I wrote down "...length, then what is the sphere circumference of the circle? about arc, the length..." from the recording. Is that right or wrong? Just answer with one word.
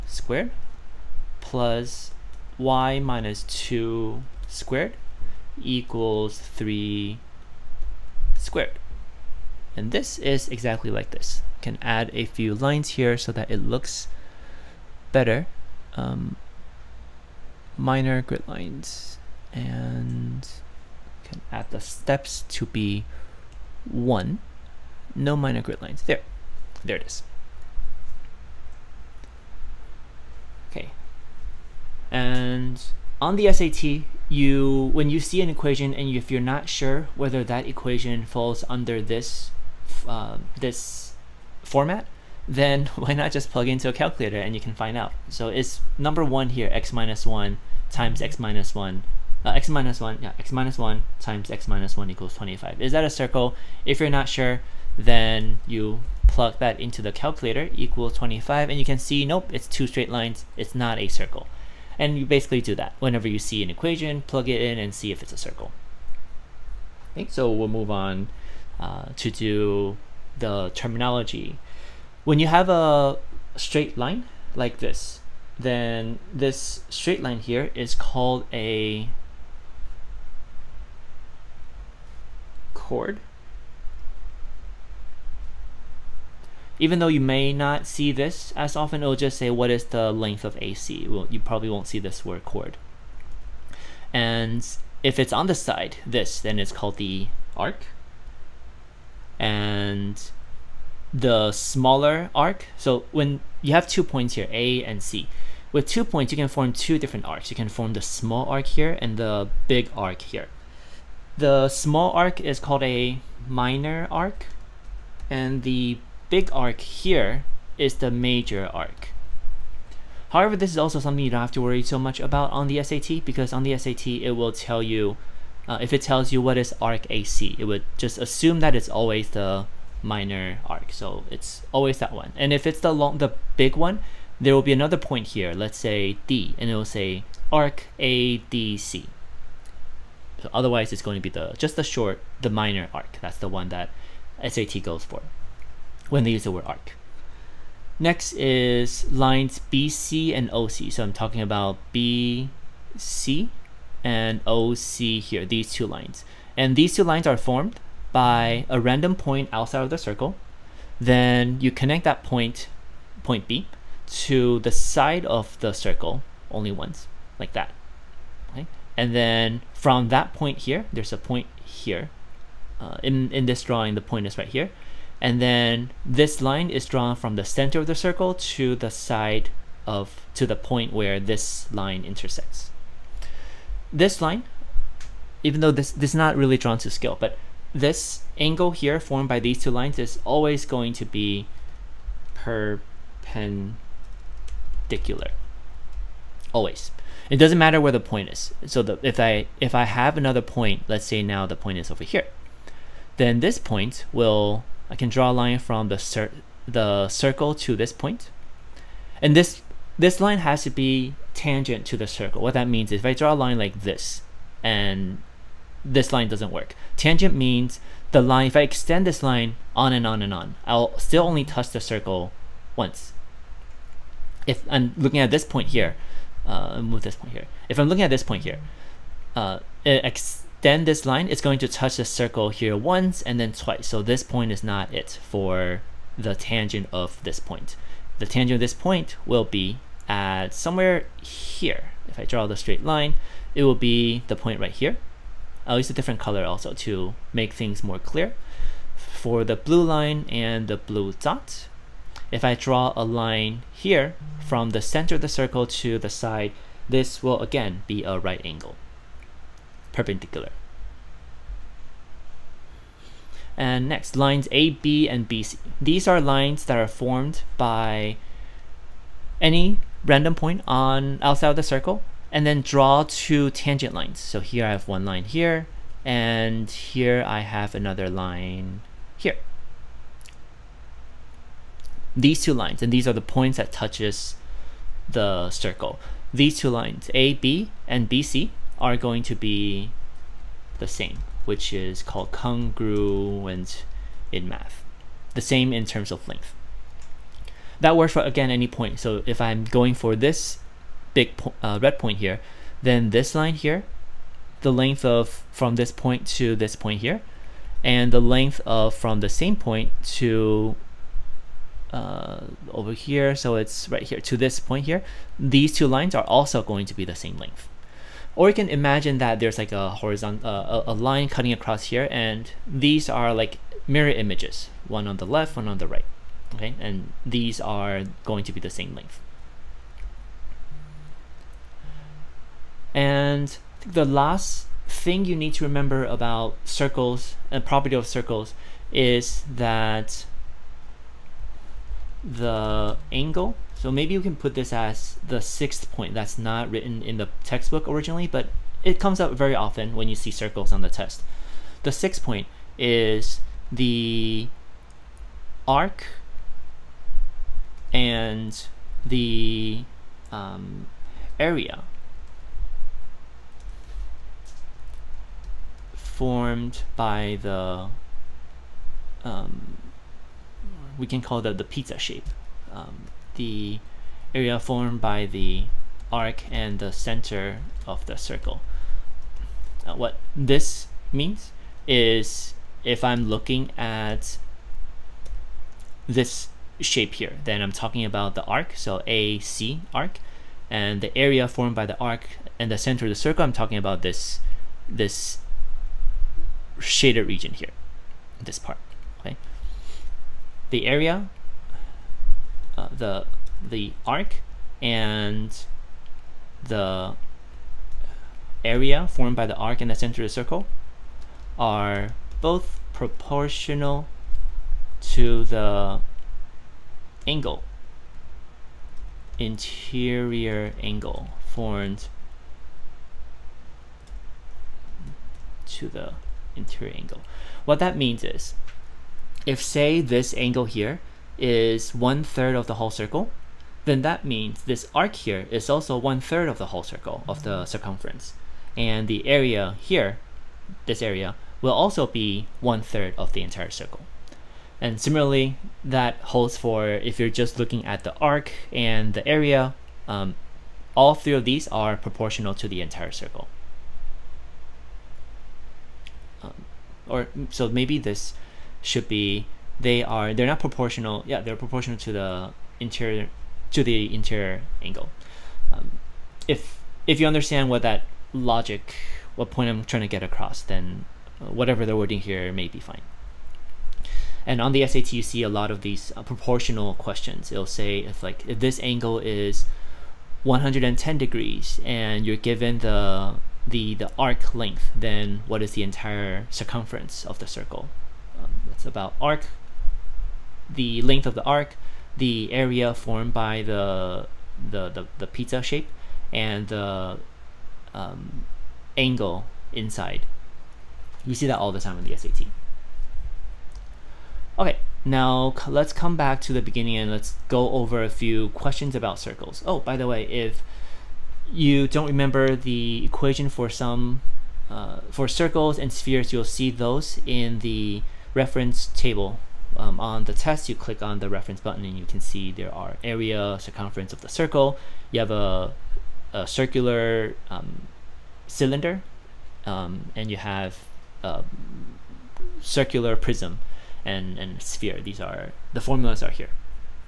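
wrong.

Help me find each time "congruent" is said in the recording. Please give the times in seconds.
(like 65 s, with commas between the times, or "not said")
292 s.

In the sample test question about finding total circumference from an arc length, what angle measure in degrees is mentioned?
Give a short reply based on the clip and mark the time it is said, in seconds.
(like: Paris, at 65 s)
110, at 480 s.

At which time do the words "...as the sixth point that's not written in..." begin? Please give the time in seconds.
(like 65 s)
344 s.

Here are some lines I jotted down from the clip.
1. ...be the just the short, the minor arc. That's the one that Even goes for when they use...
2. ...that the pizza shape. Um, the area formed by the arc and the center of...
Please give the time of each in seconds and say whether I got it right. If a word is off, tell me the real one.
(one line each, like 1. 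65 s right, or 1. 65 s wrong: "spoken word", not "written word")
1. 141 s wrong: "SAT", not "Even"
2. 371 s right.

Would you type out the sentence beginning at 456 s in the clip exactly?
Um, or so maybe this should be they are they're not proportional.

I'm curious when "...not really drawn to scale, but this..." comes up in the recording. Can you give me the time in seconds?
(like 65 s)
186 s.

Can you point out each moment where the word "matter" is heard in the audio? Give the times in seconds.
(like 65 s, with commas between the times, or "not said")
197 s.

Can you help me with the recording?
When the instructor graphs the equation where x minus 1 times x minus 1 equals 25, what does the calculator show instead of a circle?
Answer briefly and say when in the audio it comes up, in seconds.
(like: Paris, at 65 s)
two straight lines, at 59 s.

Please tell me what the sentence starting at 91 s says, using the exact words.
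Well, you probably won't see this word chord.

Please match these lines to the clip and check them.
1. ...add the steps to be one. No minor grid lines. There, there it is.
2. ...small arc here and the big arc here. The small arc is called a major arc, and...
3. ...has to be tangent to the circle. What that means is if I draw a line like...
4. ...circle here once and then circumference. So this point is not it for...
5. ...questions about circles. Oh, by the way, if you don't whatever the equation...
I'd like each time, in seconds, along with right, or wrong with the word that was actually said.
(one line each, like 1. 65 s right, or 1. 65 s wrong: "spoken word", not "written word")
1. 21 s right
2. 108 s wrong: "minor", not "major"
3. 210 s right
4. 232 s wrong: "twice", not "circumference"
5. 508 s wrong: "remember", not "whatever".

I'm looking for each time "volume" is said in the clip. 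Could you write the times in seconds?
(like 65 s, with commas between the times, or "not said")
not said.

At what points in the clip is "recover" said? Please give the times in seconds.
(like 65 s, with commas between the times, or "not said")
not said.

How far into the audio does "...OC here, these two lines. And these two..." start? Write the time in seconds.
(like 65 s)
154 s.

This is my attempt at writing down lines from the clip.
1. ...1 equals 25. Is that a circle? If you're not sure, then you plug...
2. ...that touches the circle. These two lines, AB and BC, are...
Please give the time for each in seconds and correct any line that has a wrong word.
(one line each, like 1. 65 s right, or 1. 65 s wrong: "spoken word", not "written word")
1. 51 s right
2. 283 s right.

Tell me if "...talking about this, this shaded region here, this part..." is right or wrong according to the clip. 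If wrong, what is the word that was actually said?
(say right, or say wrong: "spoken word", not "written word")
right.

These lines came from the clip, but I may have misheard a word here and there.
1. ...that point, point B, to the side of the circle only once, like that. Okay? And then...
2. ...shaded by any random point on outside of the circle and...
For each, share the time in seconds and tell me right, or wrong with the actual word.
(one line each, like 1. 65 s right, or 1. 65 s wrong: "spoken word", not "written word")
1. 162 s right
2. 266 s wrong: "formed", not "shaded".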